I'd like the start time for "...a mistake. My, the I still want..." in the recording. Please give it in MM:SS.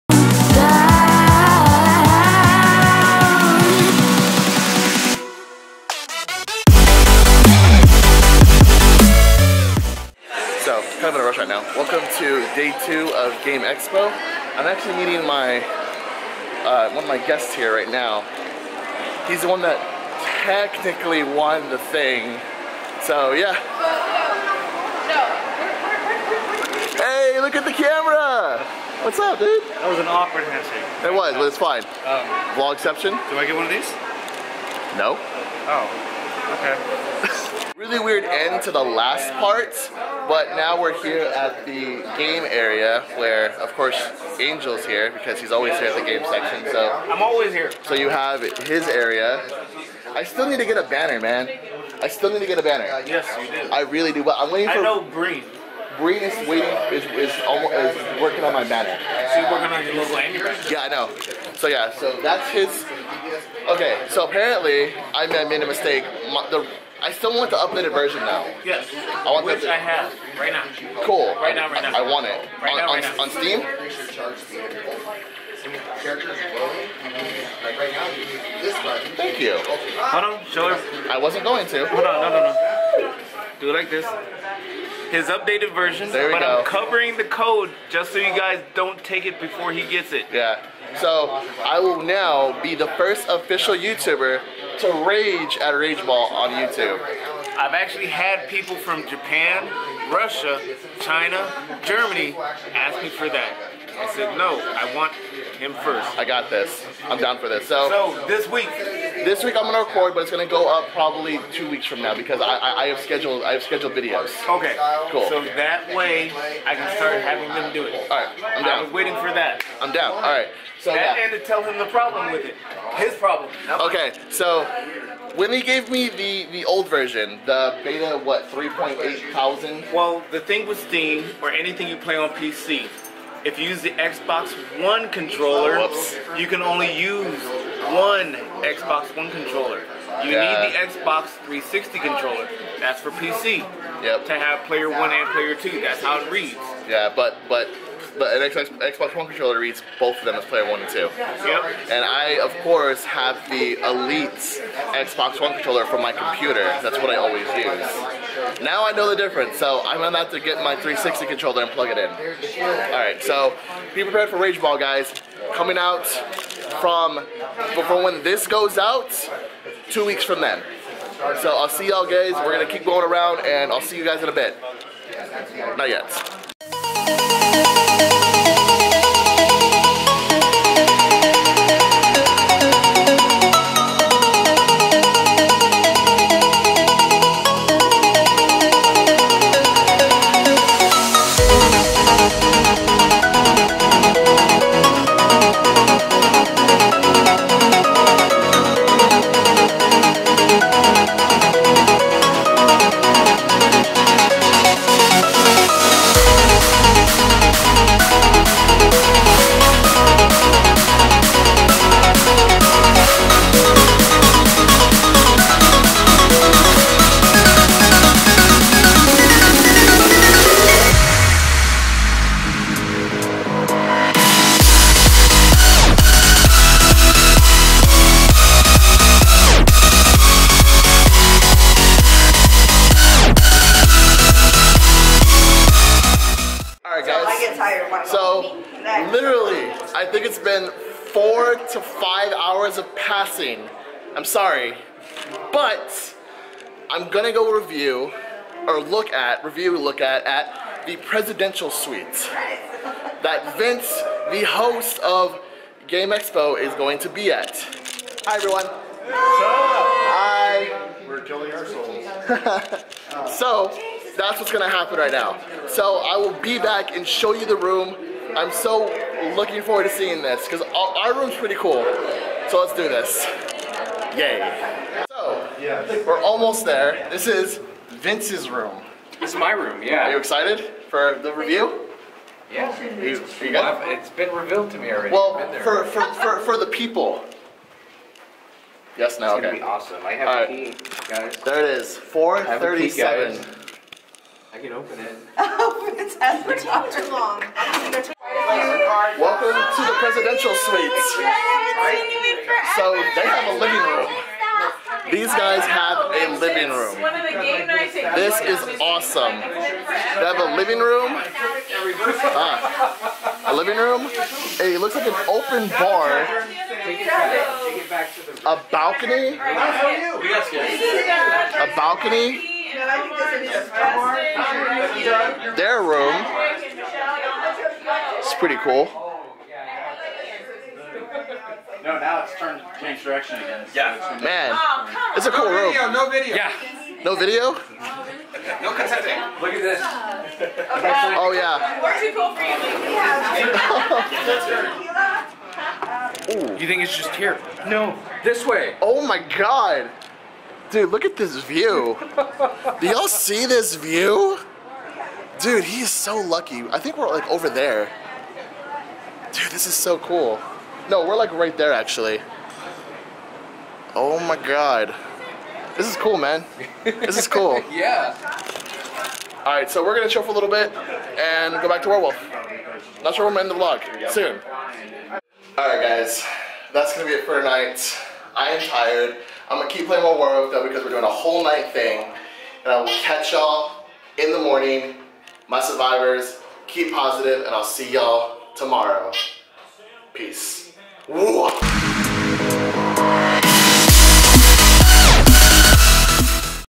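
01:05.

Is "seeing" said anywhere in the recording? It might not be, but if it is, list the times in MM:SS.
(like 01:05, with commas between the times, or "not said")
04:29.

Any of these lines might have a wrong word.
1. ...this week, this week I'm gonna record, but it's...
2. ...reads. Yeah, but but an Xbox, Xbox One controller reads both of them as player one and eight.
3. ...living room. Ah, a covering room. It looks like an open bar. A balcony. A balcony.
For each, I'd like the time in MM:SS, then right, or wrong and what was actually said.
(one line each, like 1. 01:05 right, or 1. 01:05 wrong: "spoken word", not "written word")
1. 01:48 right
2. 02:26 wrong: "two", not "eight"
3. 05:10 wrong: "living", not "covering".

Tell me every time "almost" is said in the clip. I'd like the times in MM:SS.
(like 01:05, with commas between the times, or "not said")
00:57, 04:36.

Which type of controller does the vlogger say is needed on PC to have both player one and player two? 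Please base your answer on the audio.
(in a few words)
Xbox 360 controller.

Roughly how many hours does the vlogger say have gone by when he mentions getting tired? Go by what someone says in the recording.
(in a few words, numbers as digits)
4 to 5.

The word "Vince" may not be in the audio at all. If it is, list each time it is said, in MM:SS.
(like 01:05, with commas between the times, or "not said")
04:13, 04:37.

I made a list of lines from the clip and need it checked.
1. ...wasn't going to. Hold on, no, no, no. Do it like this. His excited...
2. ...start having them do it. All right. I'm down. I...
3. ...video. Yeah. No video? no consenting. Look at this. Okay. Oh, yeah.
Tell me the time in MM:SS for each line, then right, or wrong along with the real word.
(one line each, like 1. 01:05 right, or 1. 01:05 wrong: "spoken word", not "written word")
1. 01:21 wrong: "updated", not "excited"
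2. 01:56 right
3. 05:36 right.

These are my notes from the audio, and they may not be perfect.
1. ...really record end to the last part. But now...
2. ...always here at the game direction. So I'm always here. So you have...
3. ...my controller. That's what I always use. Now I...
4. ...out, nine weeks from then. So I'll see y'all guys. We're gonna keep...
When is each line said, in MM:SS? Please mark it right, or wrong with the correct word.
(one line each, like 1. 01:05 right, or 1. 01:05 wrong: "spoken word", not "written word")
1. 00:37 wrong: "weird", not "record"
2. 00:45 wrong: "section", not "direction"
3. 02:36 wrong: "computer", not "controller"
4. 02:48 wrong: "two", not "nine".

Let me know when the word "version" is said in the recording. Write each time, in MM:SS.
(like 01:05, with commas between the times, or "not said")
01:07, 01:25, 02:06.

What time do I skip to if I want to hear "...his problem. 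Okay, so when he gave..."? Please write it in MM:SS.
02:02.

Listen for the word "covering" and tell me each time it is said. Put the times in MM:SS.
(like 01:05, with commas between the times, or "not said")
01:26.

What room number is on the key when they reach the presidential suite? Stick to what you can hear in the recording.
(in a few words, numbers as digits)
437.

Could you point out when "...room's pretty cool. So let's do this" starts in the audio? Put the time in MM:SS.
04:31.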